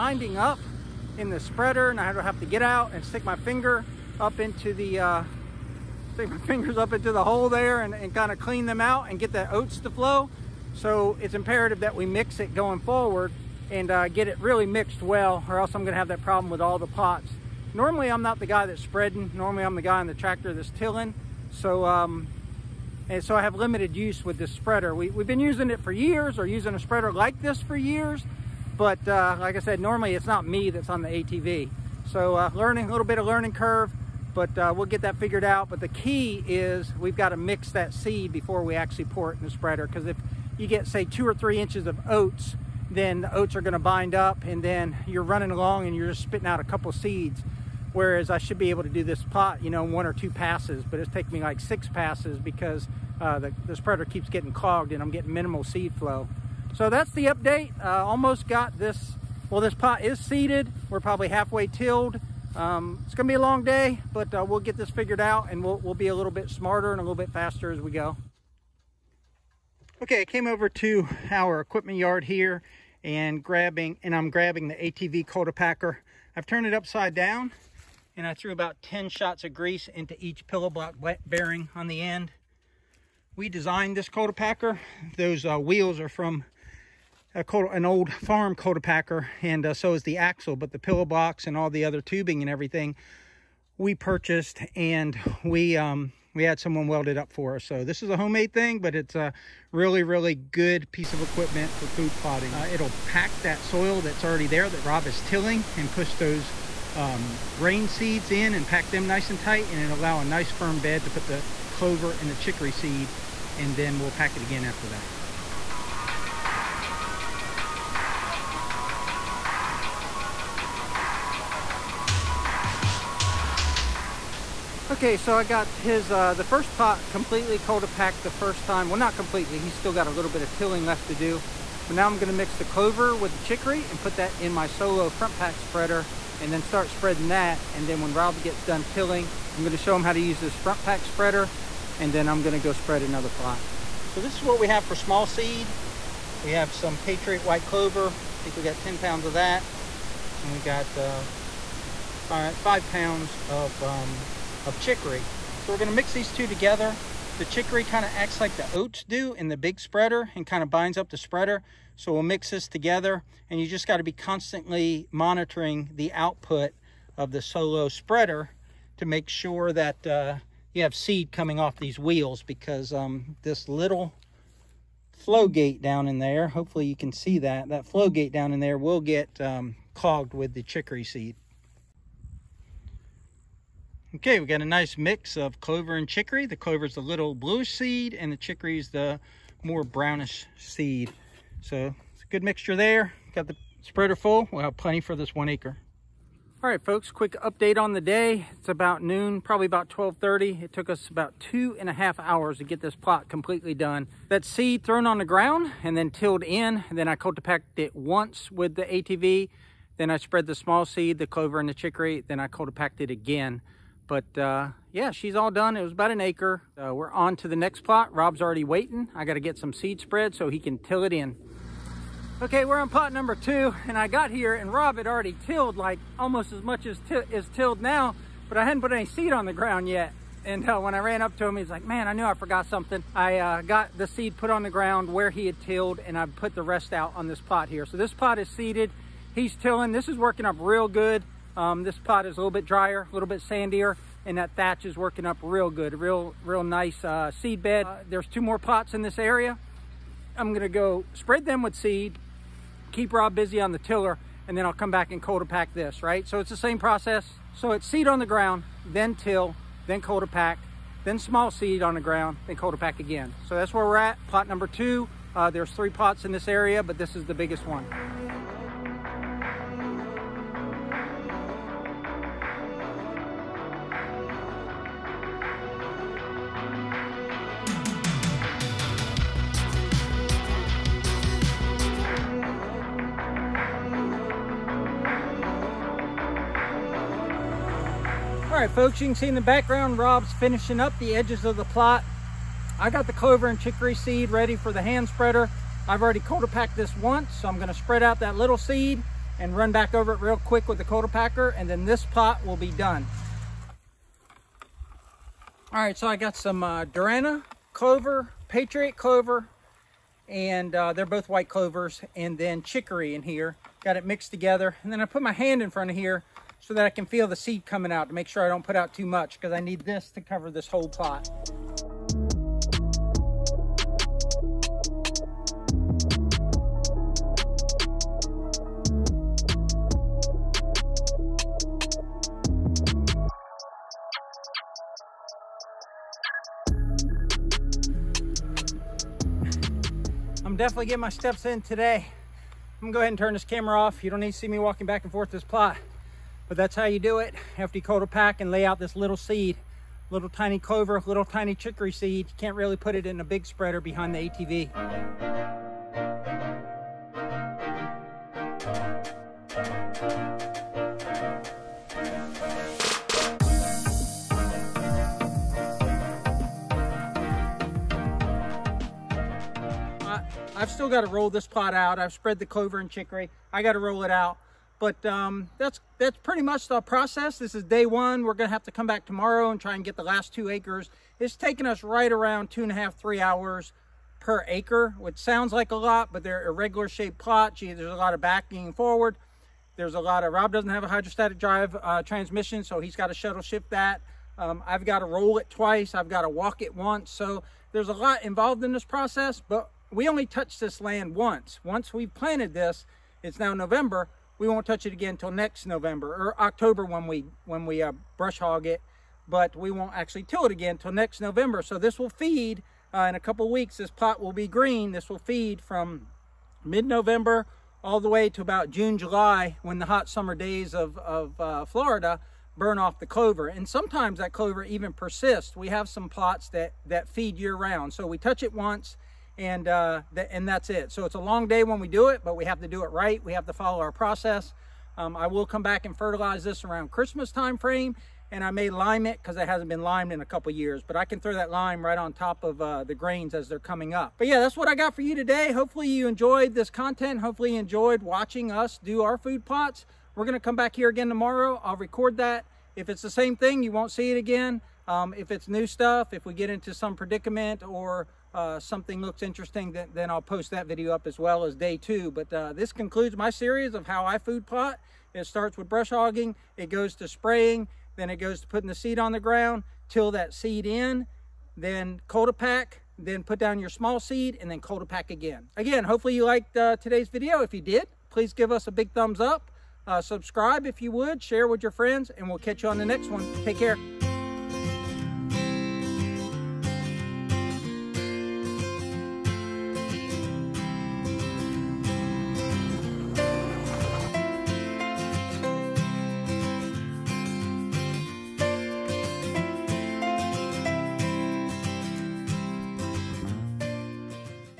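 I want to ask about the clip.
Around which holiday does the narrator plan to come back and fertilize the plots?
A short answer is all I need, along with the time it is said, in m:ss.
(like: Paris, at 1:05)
Christmas, at 7:16.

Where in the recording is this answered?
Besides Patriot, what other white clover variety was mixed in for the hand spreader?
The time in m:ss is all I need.
5:06.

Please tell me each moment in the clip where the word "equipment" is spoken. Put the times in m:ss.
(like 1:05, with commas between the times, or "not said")
1:11, 1:41.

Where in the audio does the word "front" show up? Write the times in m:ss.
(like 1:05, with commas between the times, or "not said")
2:15, 2:20, 5:15.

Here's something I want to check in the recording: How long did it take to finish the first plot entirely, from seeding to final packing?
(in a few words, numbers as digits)
2.5 hours.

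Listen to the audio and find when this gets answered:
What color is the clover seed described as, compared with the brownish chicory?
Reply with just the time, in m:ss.
3:07.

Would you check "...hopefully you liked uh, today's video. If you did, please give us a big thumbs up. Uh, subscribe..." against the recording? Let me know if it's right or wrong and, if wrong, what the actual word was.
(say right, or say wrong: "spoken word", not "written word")
right.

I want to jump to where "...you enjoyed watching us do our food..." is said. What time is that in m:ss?
7:27.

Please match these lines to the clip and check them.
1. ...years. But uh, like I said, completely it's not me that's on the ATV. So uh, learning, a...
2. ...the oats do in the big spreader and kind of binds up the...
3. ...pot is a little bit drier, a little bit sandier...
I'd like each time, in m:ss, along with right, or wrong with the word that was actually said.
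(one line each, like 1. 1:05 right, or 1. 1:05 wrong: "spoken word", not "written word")
1. 0:27 wrong: "normally", not "completely"
2. 2:38 right
3. 4:01 right.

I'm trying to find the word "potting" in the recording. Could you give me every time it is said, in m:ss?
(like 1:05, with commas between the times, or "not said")
1:42.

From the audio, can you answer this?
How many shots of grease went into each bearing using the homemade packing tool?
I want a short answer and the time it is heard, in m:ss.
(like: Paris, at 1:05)
10, at 1:18.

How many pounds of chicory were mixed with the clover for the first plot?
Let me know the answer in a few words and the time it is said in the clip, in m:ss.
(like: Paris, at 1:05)
5 pounds, at 2:32.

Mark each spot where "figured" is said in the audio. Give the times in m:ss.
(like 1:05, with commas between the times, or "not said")
0:35, 1:04.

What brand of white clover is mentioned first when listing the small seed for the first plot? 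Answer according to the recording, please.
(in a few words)
Patriot White Clover.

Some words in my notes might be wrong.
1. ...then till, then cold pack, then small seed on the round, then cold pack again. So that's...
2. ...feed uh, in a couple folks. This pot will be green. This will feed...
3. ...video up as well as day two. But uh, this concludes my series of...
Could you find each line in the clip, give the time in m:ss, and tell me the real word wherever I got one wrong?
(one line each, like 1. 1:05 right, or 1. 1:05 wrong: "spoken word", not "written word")
1. 4:18 wrong: "ground", not "round"
2. 6:52 wrong: "weeks", not "folks"
3. 7:40 right.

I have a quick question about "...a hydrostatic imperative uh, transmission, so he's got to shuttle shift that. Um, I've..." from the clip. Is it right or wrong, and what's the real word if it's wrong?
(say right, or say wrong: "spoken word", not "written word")
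wrong: "drive", not "imperative".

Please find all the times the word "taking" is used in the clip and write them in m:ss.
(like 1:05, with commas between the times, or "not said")
0:51, 6:21.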